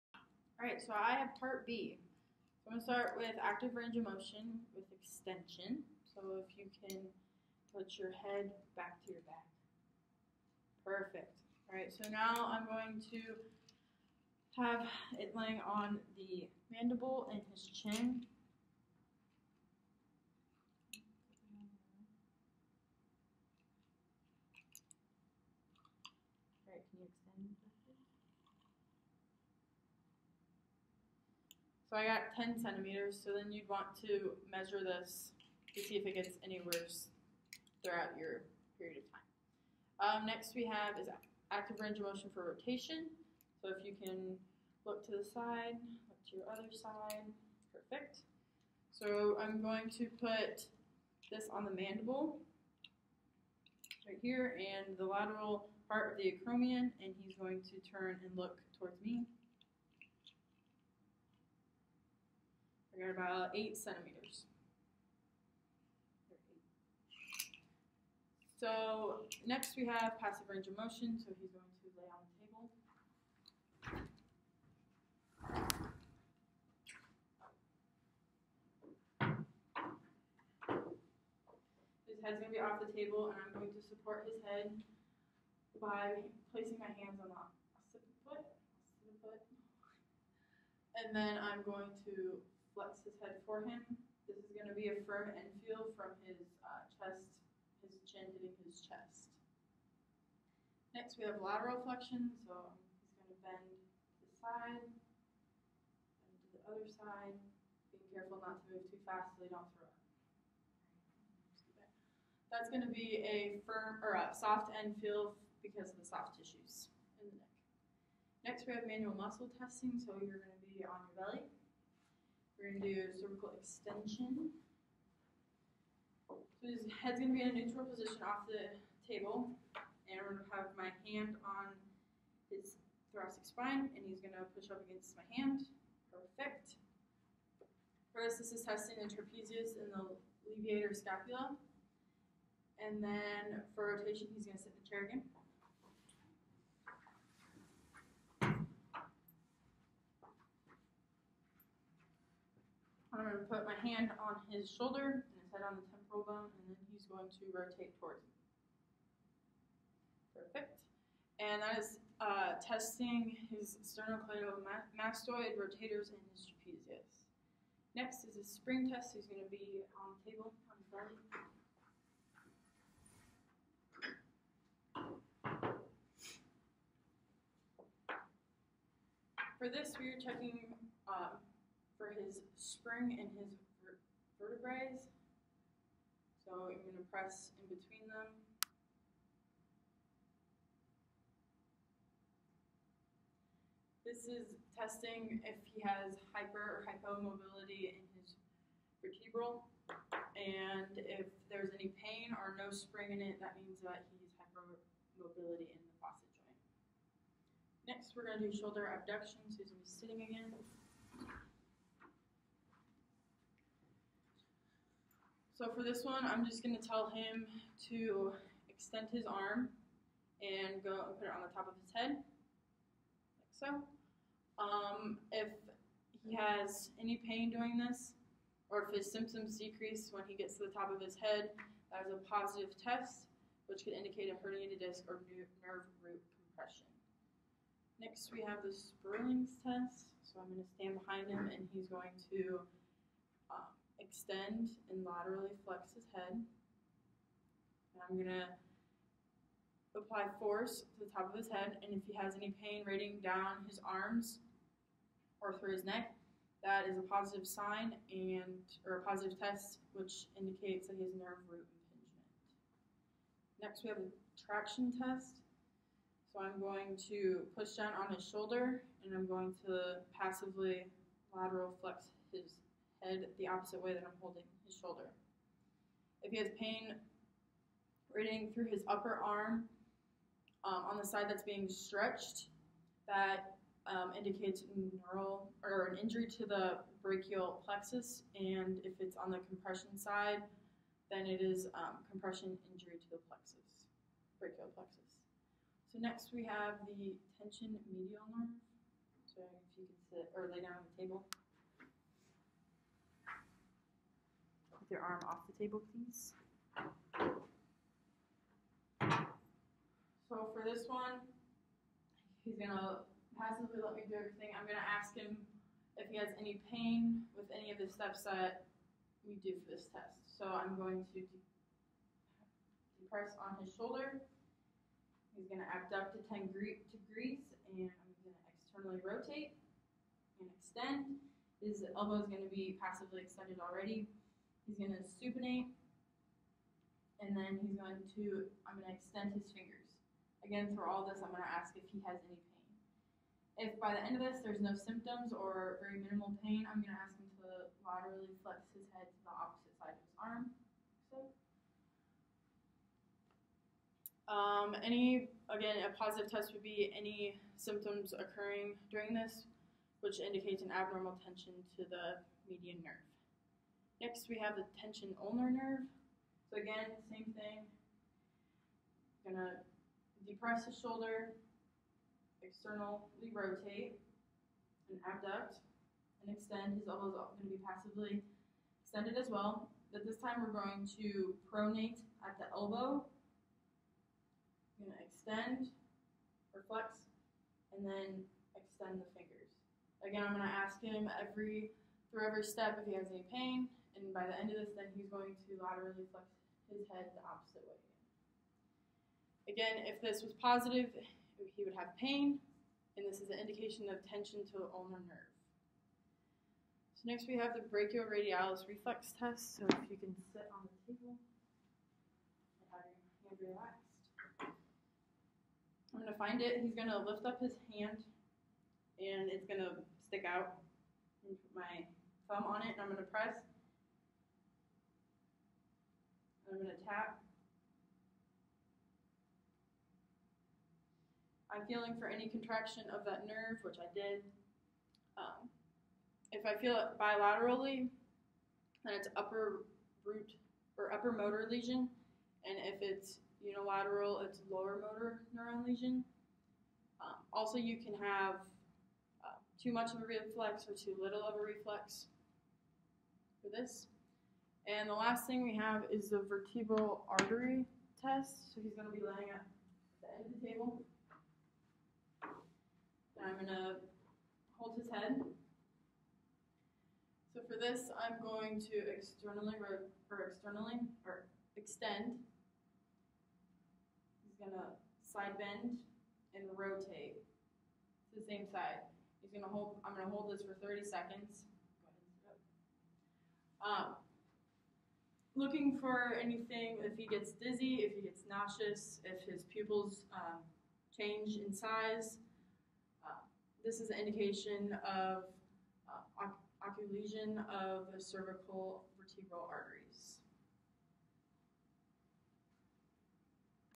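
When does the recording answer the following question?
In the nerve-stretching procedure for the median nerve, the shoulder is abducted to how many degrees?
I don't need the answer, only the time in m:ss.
5:26.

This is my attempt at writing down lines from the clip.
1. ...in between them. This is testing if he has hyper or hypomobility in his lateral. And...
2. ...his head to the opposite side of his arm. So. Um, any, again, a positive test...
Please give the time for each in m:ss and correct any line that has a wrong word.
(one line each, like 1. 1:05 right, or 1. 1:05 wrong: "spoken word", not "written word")
1. 3:07 wrong: "vertebral", not "lateral"
2. 5:48 right.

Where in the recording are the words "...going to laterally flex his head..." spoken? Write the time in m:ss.
6:35.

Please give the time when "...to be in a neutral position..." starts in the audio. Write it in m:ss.
2:07.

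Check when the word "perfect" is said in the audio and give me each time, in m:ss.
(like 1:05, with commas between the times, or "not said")
0:10, 0:47, 2:16, 2:40.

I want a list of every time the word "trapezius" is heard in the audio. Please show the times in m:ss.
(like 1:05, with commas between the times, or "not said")
2:19, 2:46.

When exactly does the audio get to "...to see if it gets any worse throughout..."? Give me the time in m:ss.
0:35.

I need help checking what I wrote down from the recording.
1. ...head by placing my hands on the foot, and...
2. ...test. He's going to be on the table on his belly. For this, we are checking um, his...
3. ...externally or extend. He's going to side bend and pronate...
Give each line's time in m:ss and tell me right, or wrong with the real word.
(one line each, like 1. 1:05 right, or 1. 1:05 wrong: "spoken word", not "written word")
1. 1:24 right
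2. 2:48 right
3. 7:50 wrong: "rotate", not "pronate".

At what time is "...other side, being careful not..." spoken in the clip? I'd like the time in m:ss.
1:46.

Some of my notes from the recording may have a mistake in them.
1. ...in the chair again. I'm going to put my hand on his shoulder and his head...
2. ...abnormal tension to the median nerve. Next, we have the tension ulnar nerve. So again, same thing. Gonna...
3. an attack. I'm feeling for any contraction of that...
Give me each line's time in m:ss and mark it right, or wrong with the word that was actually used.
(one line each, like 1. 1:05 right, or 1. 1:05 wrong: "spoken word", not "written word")
1. 2:24 right
2. 6:00 right
3. 7:06 right.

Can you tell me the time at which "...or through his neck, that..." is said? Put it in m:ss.
4:15.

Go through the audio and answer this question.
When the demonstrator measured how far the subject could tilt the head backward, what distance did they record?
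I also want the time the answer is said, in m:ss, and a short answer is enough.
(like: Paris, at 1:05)
10 centimeters, at 0:32.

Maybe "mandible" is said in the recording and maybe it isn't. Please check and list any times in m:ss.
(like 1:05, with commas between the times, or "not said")
0:16, 0:51.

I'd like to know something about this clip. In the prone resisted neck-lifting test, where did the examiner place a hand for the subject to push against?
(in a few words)
thoracic spine.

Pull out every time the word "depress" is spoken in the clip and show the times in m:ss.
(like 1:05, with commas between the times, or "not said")
5:22, 6:10.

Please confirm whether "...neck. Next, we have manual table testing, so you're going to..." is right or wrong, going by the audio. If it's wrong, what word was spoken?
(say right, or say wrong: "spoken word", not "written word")
wrong: "muscle", not "table".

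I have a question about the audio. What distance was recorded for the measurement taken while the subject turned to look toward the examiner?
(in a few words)
8 centimeters.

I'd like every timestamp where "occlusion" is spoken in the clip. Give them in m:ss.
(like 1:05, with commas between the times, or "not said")
8:16.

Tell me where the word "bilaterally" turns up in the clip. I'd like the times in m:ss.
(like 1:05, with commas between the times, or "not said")
7:16.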